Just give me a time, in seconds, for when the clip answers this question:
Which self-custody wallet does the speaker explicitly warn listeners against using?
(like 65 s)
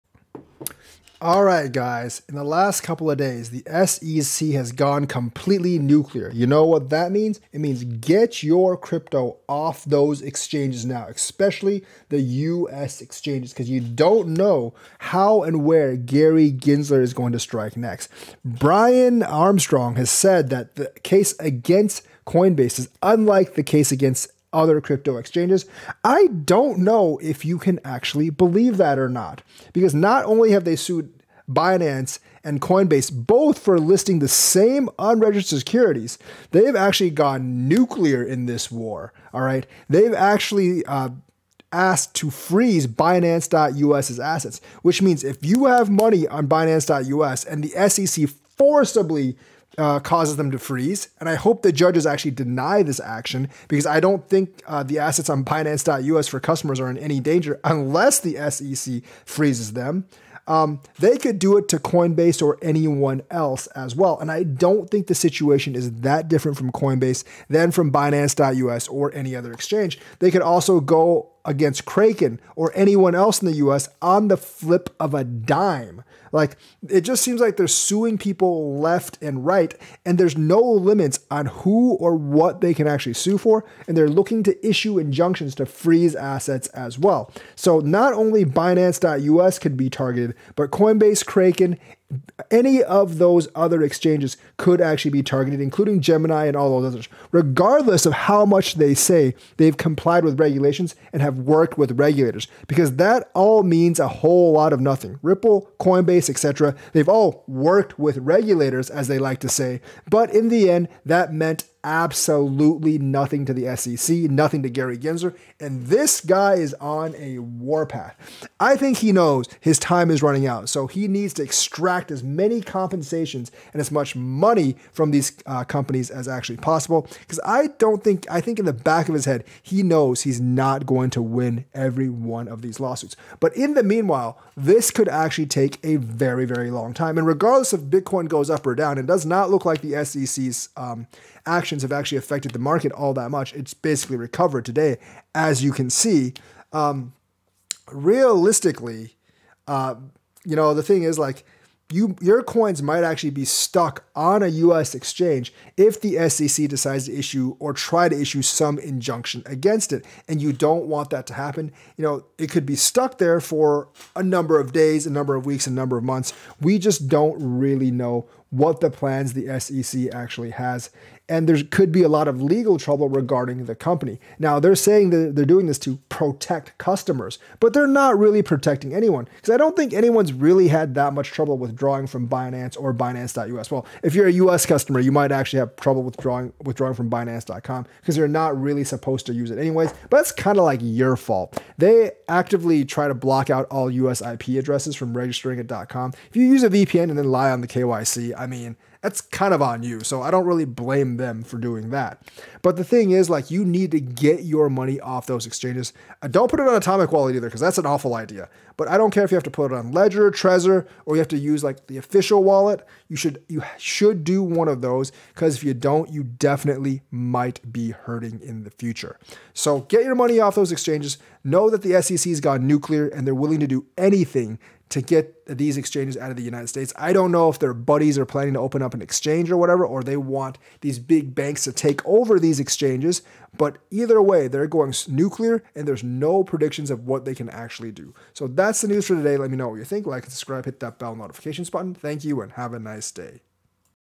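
206 s.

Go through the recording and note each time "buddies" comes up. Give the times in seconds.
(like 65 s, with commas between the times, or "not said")
227 s.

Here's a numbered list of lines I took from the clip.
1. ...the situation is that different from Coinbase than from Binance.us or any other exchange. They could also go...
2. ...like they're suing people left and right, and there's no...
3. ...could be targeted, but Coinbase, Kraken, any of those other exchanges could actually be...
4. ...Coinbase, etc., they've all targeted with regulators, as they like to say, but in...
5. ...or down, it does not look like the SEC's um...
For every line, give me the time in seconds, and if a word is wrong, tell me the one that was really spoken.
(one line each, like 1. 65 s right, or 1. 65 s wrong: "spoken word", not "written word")
1. 65 s right
2. 77 s right
3. 89 s right
4. 105 s wrong: "worked", not "targeted"
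5. 138 s right.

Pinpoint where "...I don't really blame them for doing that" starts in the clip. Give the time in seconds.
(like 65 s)
200 s.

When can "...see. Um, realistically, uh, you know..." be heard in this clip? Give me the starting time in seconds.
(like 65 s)
145 s.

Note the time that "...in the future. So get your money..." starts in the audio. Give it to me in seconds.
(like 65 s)
218 s.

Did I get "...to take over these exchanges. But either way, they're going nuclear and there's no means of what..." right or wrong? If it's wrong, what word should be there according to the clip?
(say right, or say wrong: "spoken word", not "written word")
wrong: "predictions", not "means".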